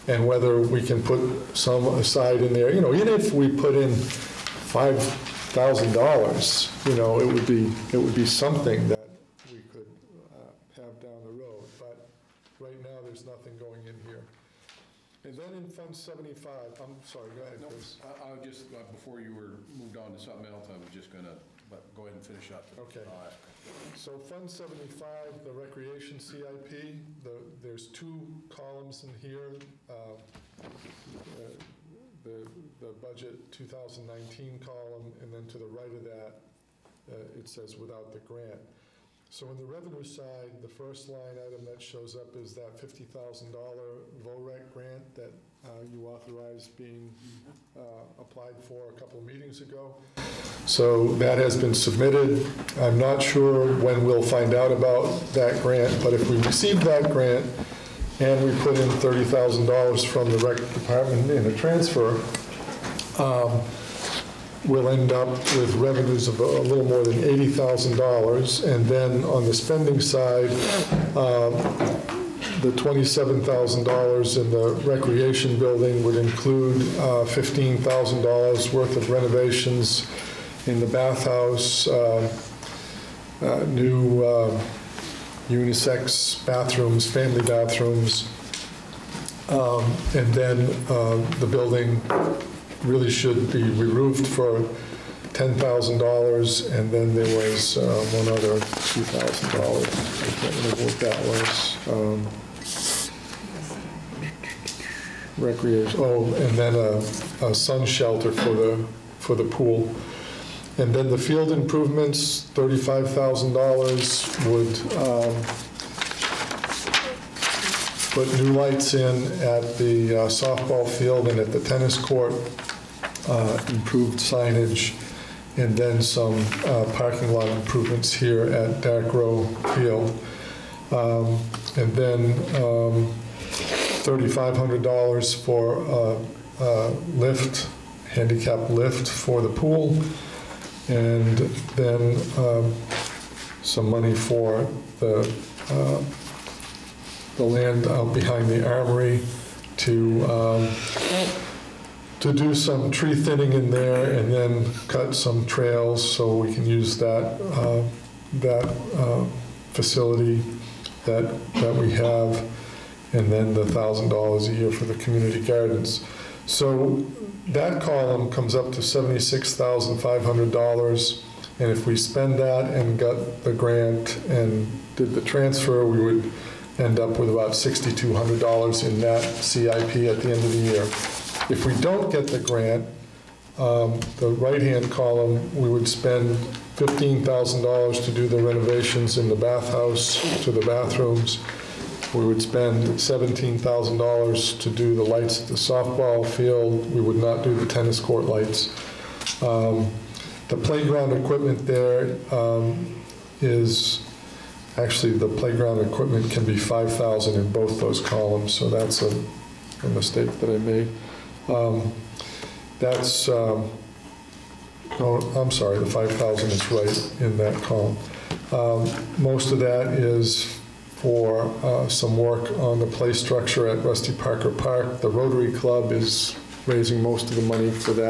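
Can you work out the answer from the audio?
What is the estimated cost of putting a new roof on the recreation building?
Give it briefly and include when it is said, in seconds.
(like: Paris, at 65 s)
$10,000, at 95 s.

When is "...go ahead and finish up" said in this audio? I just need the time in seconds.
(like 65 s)
21 s.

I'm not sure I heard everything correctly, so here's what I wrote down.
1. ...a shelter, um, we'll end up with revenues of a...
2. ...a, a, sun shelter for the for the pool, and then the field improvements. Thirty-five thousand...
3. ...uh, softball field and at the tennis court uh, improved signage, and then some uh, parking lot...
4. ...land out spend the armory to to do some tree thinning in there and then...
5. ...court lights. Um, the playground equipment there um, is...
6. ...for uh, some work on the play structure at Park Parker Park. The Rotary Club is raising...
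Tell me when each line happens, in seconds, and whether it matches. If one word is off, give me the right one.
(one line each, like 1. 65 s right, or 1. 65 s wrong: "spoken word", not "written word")
1. 61 s wrong: "transfer", not "shelter"
2. 106 s right
3. 120 s right
4. 147 s wrong: "behind", not "spend"
5. 197 s right
6. 220 s wrong: "Rusty", not "Park".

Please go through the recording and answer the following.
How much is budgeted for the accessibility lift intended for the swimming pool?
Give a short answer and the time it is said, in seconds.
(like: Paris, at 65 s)
$3,500, at 134 s.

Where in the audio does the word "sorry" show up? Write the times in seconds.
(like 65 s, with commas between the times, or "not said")
17 s, 215 s.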